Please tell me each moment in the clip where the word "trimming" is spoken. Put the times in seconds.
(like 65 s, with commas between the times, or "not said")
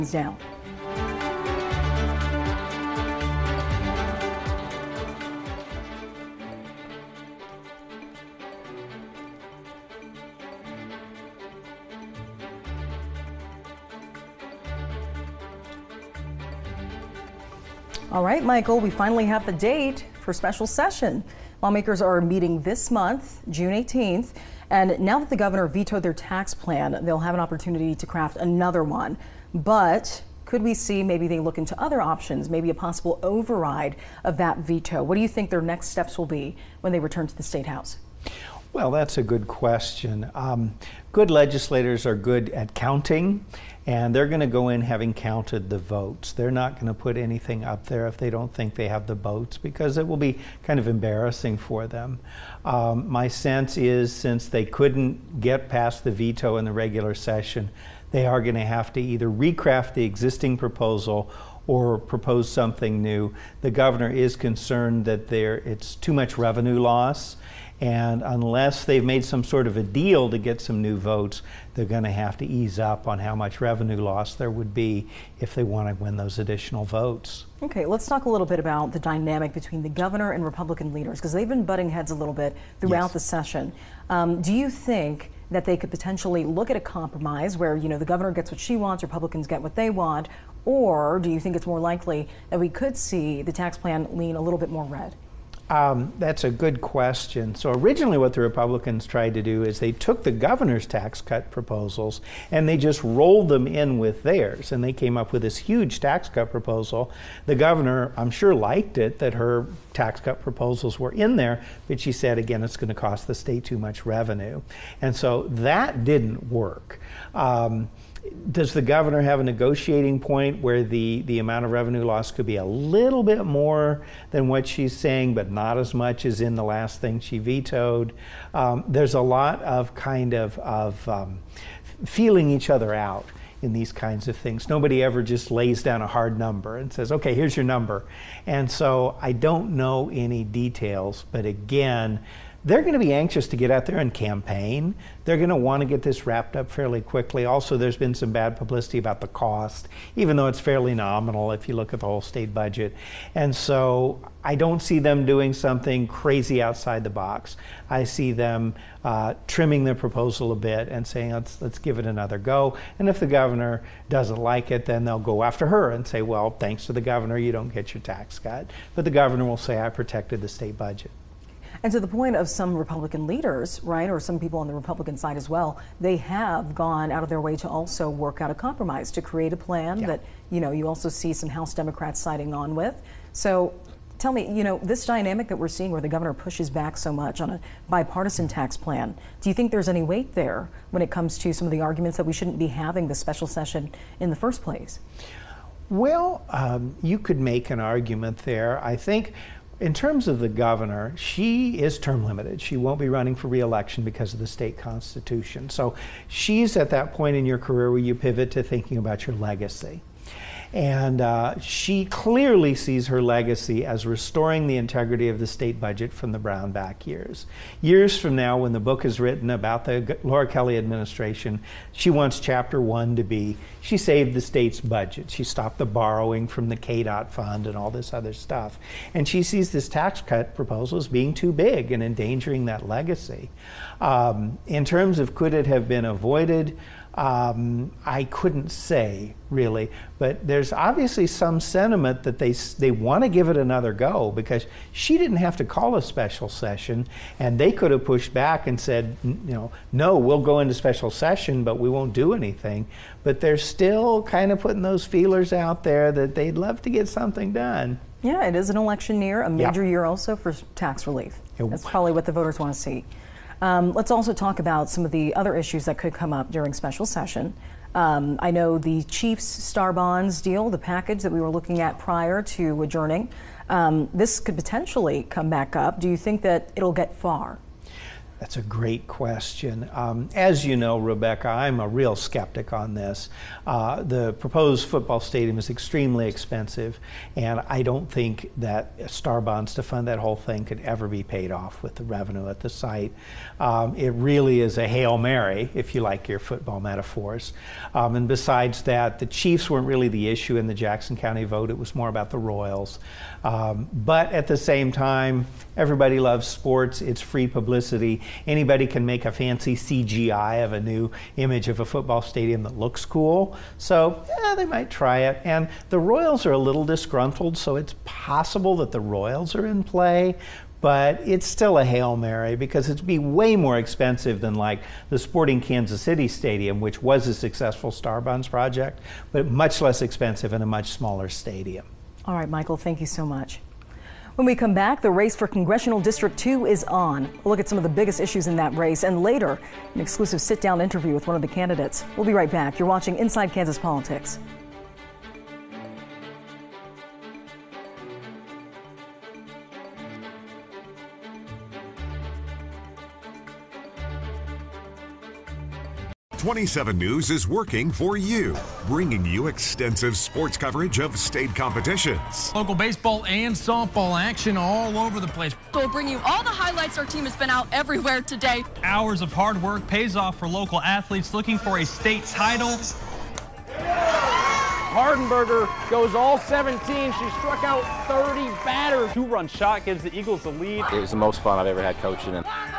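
159 s.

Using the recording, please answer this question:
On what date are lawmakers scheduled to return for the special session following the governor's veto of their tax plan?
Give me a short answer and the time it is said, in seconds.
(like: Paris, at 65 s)
June 18, at 23 s.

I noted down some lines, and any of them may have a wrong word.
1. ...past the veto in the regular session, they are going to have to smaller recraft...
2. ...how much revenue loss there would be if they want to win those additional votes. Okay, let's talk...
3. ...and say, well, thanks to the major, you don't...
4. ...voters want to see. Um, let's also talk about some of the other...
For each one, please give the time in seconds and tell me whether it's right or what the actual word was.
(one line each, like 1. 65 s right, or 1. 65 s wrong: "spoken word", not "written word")
1. 55 s wrong: "either", not "smaller"
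2. 73 s right
3. 165 s wrong: "governor", not "major"
4. 262 s right.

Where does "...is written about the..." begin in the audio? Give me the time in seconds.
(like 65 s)
219 s.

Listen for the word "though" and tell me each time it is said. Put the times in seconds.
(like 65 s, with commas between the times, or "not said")
150 s.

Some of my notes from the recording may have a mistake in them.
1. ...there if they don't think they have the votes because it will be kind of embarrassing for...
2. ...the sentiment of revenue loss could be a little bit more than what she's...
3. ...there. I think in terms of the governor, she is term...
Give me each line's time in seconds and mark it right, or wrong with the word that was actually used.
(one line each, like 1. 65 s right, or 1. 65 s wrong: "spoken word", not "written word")
1. 47 s right
2. 121 s wrong: "amount", not "sentiment"
3. 198 s right.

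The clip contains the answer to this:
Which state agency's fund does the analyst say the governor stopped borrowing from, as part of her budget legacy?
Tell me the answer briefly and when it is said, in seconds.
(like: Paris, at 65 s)
KDOT, at 226 s.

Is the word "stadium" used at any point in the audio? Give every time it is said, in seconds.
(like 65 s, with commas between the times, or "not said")
285 s, 312 s, 326 s, 331 s.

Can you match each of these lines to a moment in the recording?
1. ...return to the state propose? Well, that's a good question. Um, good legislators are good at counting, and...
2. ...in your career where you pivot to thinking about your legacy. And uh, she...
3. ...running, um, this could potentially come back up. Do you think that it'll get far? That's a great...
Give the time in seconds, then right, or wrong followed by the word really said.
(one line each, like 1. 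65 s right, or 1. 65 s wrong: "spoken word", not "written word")
1. 36 s wrong: "house", not "propose"
2. 207 s right
3. 272 s wrong: "adjourning", not "running".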